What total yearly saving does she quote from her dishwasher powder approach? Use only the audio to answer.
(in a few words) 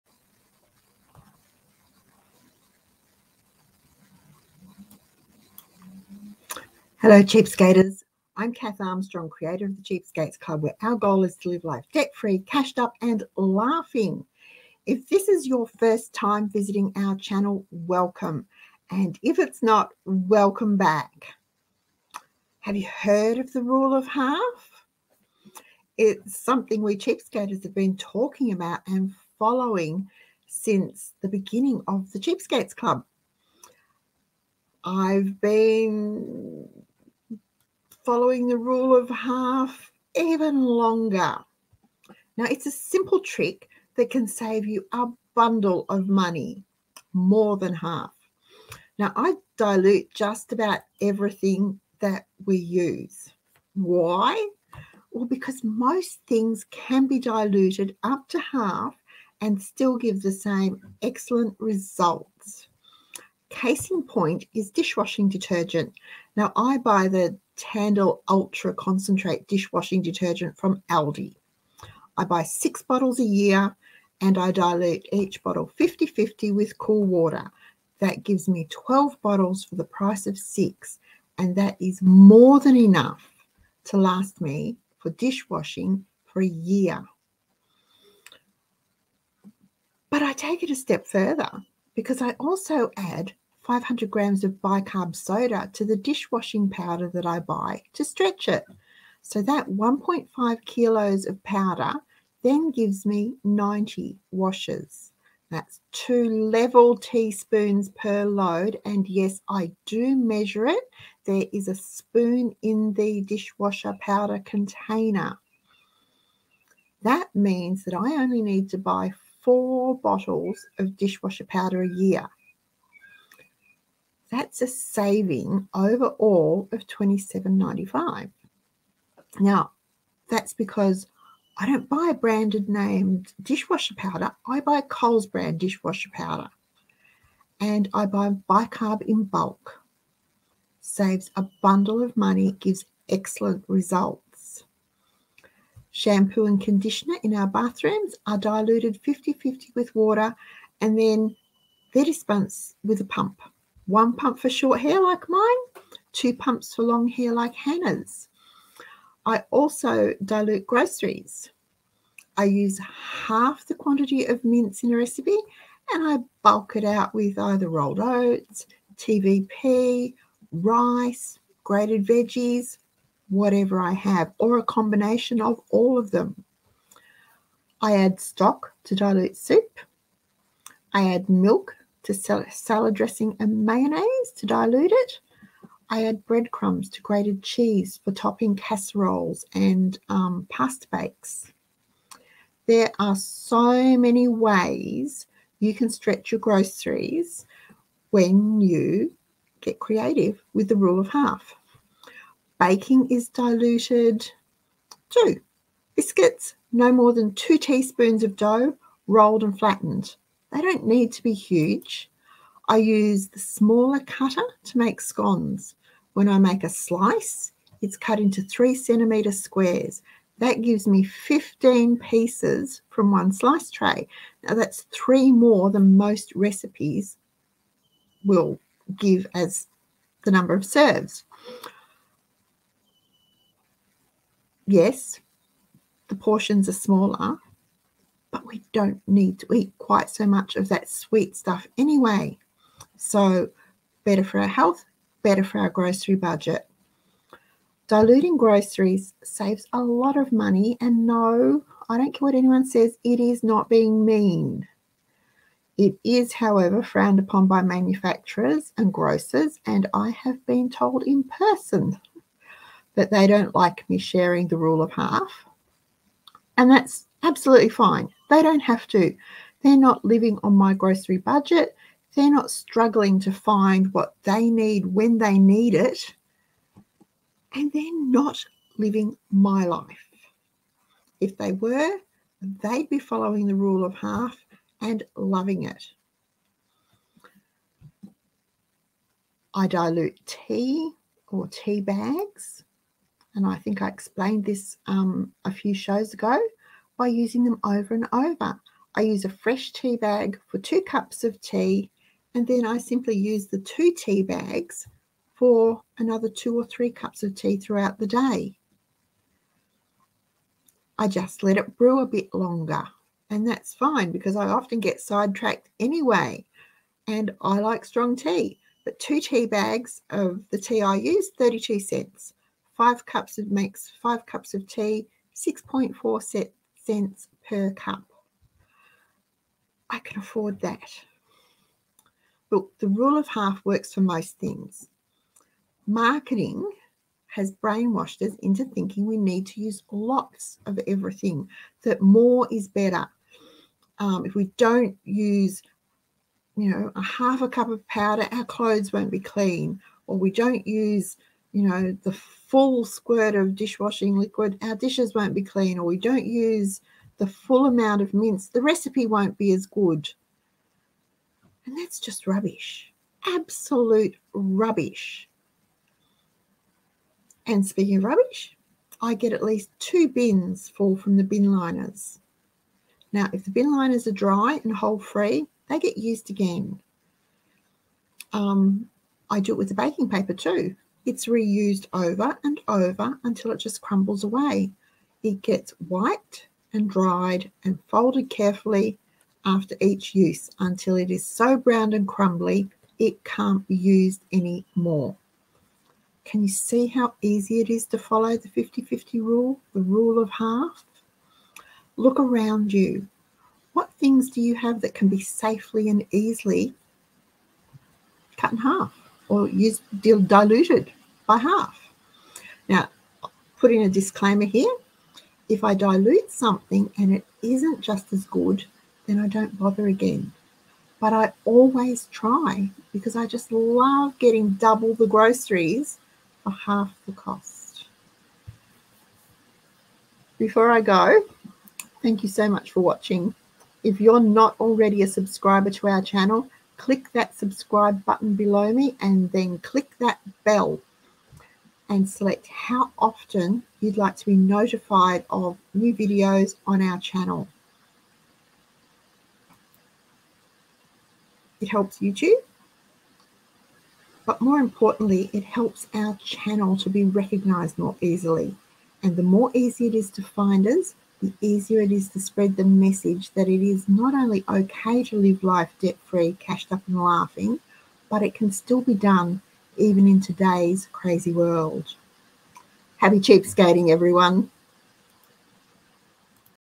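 $27.95.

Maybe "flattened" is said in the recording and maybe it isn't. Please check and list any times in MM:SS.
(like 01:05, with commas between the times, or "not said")
03:29.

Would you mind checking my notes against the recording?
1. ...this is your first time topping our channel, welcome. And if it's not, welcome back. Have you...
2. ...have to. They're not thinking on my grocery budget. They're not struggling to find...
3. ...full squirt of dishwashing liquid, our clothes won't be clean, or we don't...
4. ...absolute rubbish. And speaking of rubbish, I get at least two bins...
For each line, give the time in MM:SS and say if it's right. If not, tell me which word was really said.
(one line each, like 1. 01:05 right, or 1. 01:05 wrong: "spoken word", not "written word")
1. 00:15 wrong: "visiting", not "topping"
2. 04:28 wrong: "living", not "thinking"
3. 05:52 wrong: "dishes", not "clothes"
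4. 06:03 right.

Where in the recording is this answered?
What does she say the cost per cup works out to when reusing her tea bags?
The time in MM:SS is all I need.
05:25.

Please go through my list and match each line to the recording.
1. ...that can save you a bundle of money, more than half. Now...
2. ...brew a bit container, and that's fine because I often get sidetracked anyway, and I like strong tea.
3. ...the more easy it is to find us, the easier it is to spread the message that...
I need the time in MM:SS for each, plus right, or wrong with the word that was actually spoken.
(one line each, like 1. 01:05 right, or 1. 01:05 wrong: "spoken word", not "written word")
1. 00:43 right
2. 05:11 wrong: "longer", not "container"
3. 07:39 right.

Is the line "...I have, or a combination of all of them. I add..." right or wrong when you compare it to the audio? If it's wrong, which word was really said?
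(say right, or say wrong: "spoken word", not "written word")
right.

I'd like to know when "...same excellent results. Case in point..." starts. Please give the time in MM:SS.
01:00.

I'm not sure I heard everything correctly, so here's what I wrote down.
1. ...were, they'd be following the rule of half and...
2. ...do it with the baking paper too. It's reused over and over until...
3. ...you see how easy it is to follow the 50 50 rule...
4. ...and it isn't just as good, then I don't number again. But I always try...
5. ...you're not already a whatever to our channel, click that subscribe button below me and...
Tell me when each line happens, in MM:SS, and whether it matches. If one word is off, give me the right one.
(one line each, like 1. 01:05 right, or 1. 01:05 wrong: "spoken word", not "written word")
1. 04:41 right
2. 06:19 right
3. 06:36 right
4. 06:56 wrong: "bother", not "number"
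5. 07:14 wrong: "subscriber", not "whatever".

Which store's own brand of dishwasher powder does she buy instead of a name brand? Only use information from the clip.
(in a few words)
Coles.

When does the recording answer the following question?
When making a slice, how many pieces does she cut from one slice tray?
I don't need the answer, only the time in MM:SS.
03:41.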